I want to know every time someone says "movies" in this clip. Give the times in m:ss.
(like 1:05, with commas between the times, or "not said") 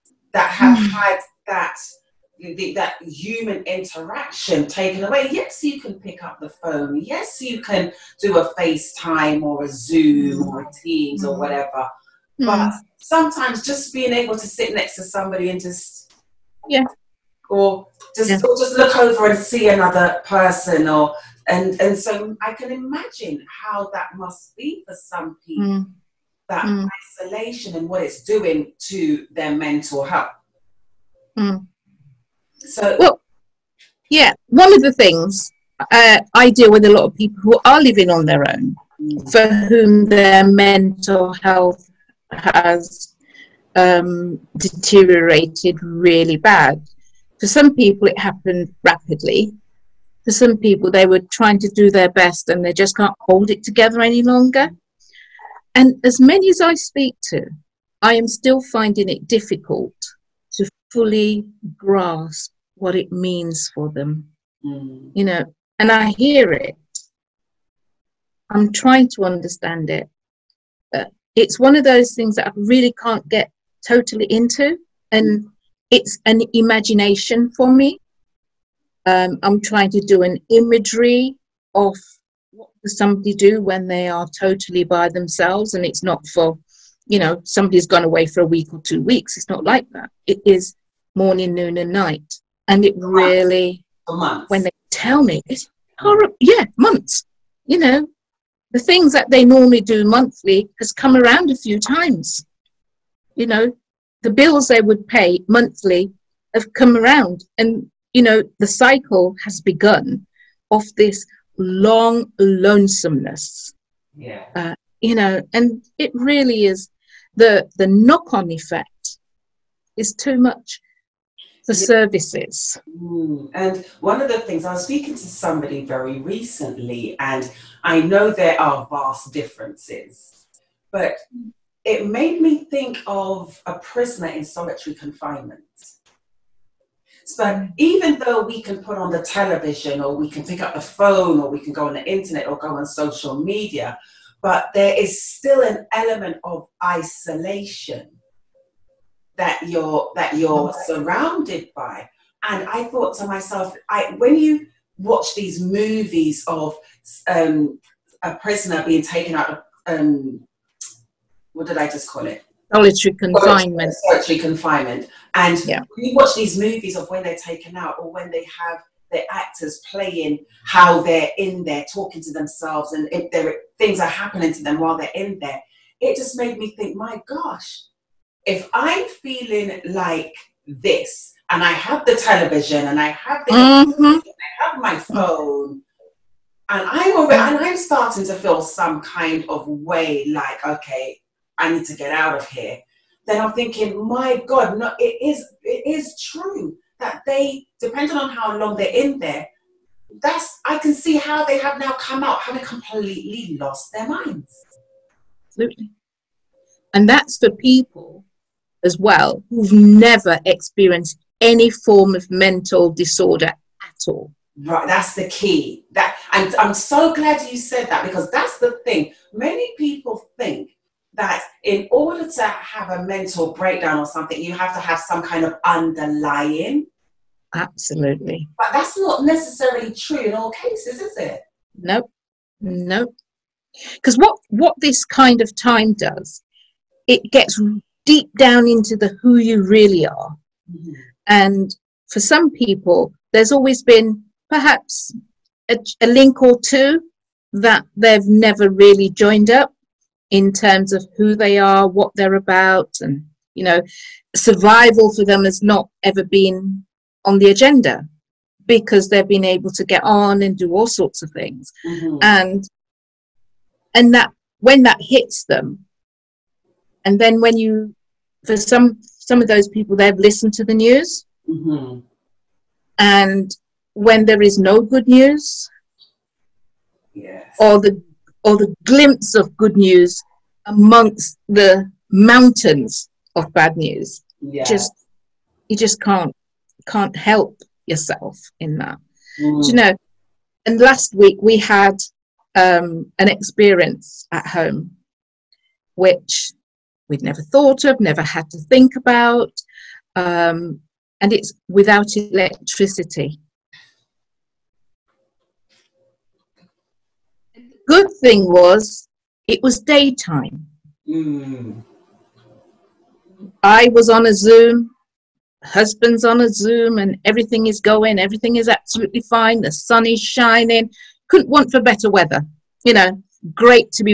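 2:35, 2:46.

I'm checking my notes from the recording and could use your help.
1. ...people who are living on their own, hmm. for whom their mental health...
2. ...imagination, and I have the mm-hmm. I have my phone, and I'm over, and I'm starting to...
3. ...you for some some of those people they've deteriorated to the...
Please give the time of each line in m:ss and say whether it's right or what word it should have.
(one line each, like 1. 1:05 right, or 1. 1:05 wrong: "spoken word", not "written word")
1. 0:37 right
2. 3:02 wrong: "television", not "imagination"
3. 4:27 wrong: "listened", not "deteriorated".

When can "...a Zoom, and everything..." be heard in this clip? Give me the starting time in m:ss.
5:16.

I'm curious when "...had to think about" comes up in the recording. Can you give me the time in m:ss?
4:58.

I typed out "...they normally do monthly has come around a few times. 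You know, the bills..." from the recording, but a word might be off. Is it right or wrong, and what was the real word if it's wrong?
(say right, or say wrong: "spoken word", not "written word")
right.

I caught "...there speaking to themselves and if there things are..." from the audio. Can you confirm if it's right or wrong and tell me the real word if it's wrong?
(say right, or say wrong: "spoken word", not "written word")
wrong: "talking", not "speaking".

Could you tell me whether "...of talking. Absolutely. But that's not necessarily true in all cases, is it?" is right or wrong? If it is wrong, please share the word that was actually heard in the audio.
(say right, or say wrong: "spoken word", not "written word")
wrong: "underlying", not "talking".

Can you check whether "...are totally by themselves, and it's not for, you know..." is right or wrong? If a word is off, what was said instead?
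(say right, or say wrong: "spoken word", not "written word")
right.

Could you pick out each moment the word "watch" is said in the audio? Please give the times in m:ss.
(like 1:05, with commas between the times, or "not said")
2:34, 2:46.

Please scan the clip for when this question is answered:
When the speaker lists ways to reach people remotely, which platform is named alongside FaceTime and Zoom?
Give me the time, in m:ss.
0:10.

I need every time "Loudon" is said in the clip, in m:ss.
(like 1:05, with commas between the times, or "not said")
not said.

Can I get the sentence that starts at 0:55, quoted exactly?
And as many as I speak to, I am still finding it difficult to fully grasp what it means for them.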